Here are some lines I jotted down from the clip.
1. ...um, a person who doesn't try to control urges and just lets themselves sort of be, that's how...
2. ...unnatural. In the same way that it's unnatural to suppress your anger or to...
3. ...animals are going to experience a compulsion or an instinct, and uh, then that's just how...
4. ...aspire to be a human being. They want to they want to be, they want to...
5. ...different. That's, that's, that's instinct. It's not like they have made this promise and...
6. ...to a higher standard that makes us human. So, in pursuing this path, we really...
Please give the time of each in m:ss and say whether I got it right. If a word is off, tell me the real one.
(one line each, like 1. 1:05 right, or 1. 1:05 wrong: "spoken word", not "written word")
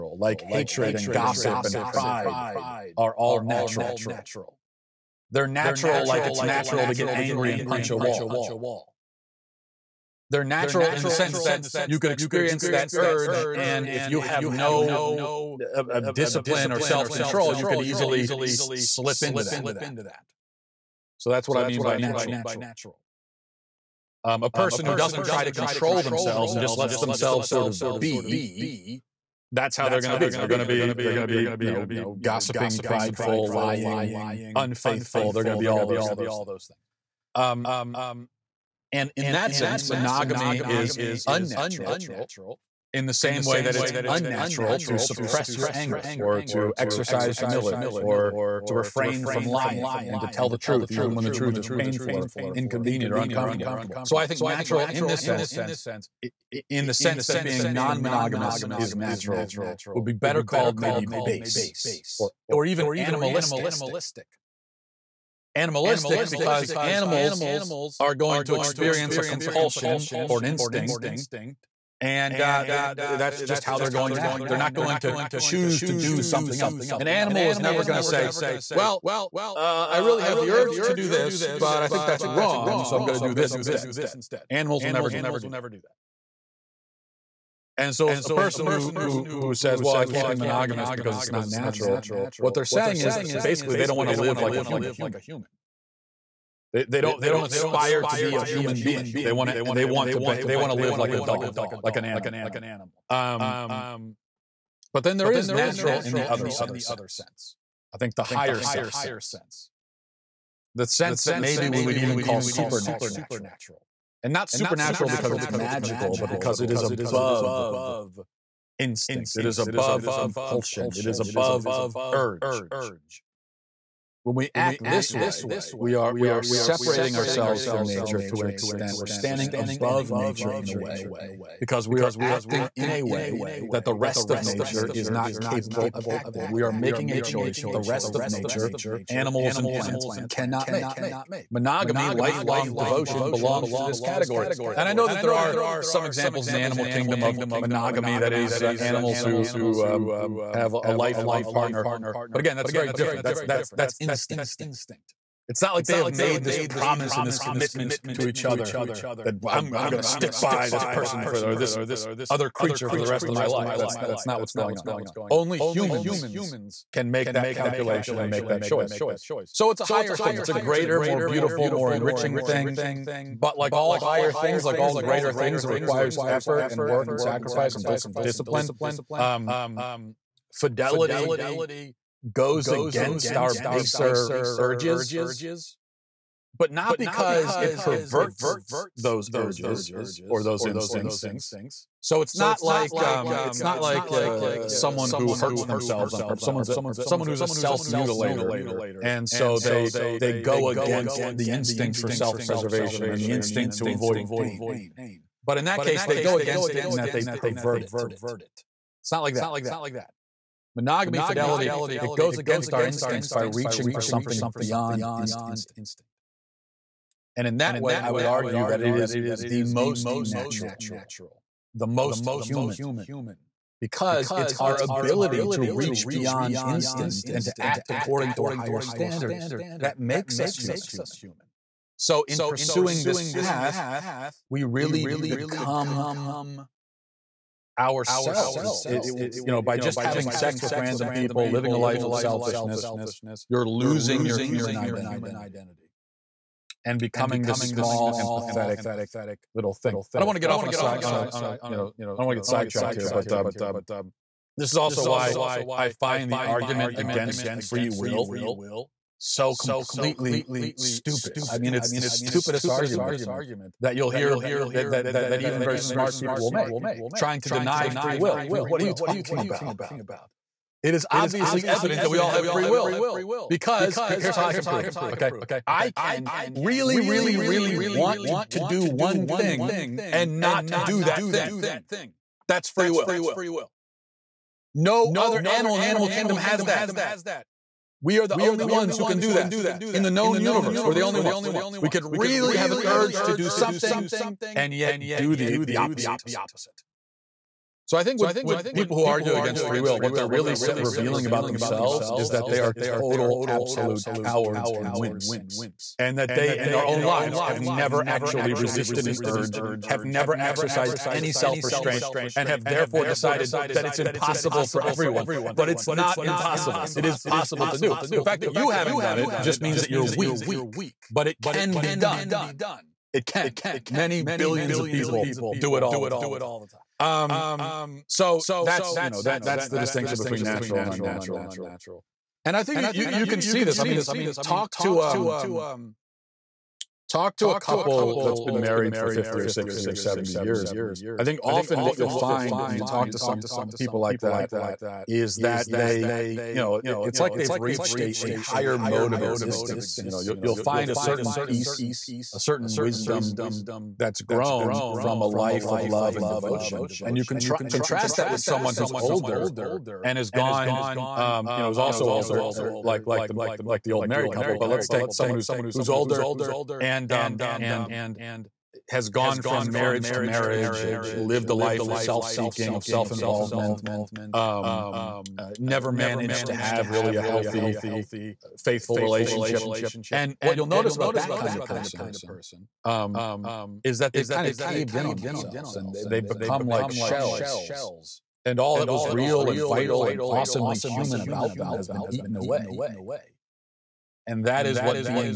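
1. 0:24 wrong: "themselves", not "urges"
2. 0:41 right
3. 1:06 right
4. 1:37 right
5. 2:32 right
6. 3:48 right.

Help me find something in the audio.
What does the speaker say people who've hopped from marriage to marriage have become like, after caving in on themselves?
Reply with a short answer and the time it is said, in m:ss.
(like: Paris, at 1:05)
shells, at 6:26.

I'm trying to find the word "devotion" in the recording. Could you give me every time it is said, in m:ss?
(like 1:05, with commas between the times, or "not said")
2:22, 5:56.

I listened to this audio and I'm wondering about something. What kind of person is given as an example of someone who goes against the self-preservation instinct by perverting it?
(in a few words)
self mutilator.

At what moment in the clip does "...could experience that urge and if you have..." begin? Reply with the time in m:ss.
0:11.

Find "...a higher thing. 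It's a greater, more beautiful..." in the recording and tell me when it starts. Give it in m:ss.
2:49.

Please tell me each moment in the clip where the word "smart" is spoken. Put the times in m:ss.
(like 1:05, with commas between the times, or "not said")
4:25.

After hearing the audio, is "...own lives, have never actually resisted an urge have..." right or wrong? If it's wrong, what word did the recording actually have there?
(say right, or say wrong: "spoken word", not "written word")
right.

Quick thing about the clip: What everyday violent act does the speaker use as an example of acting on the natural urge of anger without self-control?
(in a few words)
punch a wall.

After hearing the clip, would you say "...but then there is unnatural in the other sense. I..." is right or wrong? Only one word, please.
wrong.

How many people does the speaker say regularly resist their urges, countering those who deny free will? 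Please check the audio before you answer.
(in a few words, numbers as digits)
Many billions.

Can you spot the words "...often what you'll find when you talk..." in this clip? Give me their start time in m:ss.
5:41.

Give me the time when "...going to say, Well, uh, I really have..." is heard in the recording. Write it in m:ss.
1:17.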